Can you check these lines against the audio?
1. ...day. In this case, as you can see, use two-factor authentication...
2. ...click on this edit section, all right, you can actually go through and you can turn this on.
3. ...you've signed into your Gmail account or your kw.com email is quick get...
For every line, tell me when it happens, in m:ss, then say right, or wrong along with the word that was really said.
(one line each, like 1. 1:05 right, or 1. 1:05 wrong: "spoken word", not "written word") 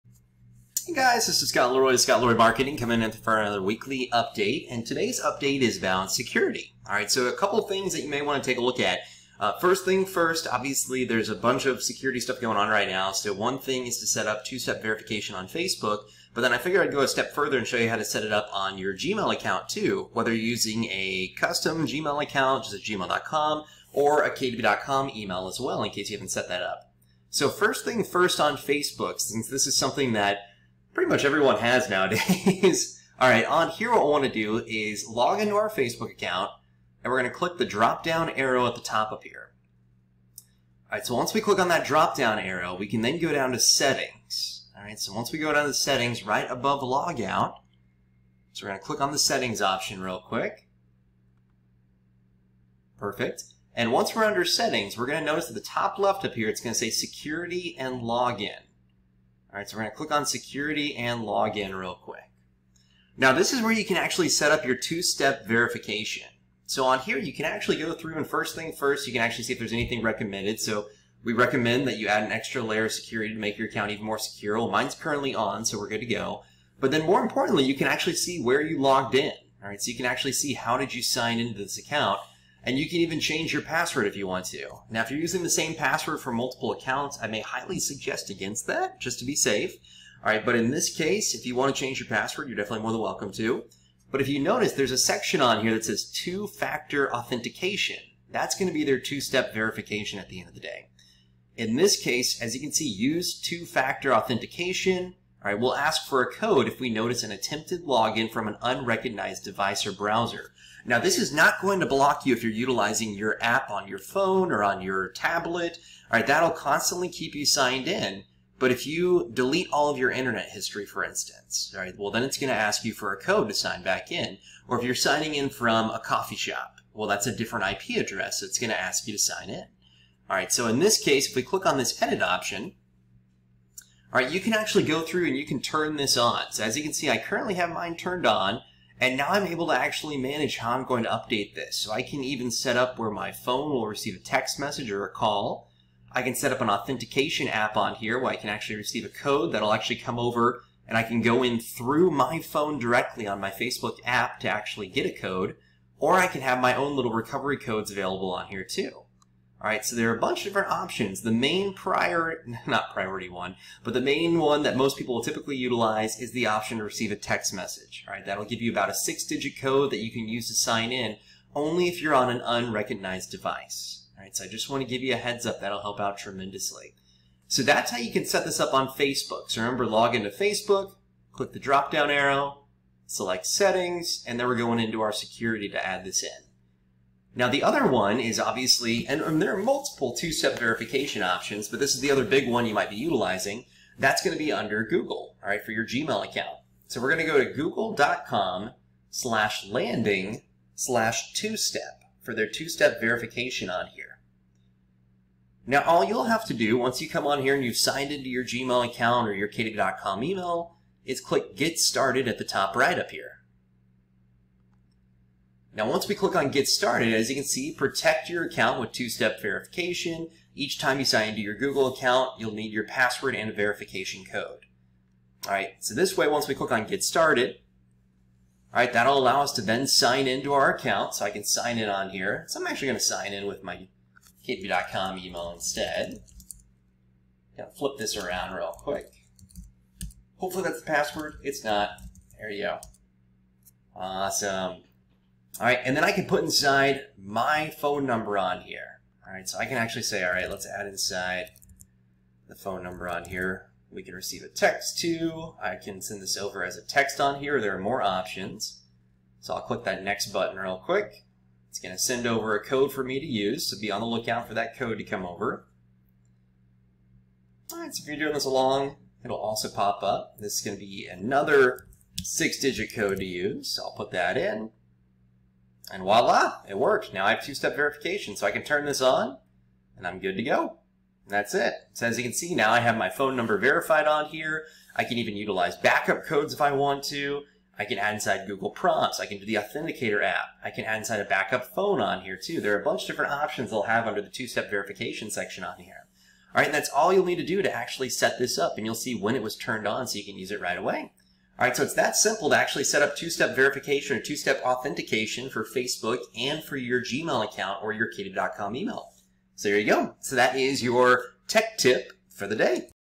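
1. 1:40 right
2. 2:11 wrong: "option", not "section"
3. 3:27 wrong: "click", not "quick".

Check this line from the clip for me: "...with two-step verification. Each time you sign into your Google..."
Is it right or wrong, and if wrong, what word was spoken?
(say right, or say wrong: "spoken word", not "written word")
right.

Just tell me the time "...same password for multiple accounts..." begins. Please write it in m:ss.
1:25.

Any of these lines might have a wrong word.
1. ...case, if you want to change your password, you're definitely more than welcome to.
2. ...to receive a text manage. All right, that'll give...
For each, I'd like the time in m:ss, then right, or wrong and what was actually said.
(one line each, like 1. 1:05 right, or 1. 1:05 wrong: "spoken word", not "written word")
1. 1:30 right
2. 2:46 wrong: "message", not "manage".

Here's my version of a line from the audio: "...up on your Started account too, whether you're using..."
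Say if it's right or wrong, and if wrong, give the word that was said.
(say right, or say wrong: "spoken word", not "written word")
wrong: "Gmail", not "Started".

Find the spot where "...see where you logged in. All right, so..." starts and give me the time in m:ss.
1:18.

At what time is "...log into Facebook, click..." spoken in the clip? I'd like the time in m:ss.
2:59.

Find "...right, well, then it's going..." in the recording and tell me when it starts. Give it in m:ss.
2:01.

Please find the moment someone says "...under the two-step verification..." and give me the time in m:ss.
4:54.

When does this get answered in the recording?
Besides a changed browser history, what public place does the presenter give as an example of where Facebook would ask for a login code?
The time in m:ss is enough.
2:05.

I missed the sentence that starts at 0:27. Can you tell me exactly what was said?
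So first thing first on Facebook, since this is something that pretty much everyone has nowadays.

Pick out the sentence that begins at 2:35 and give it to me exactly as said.
Or I can have my own little recovery codes available on here too.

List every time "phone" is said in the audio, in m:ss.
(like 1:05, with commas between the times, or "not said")
1:53, 2:23, 2:32, 4:07, 4:12, 4:43, 4:51.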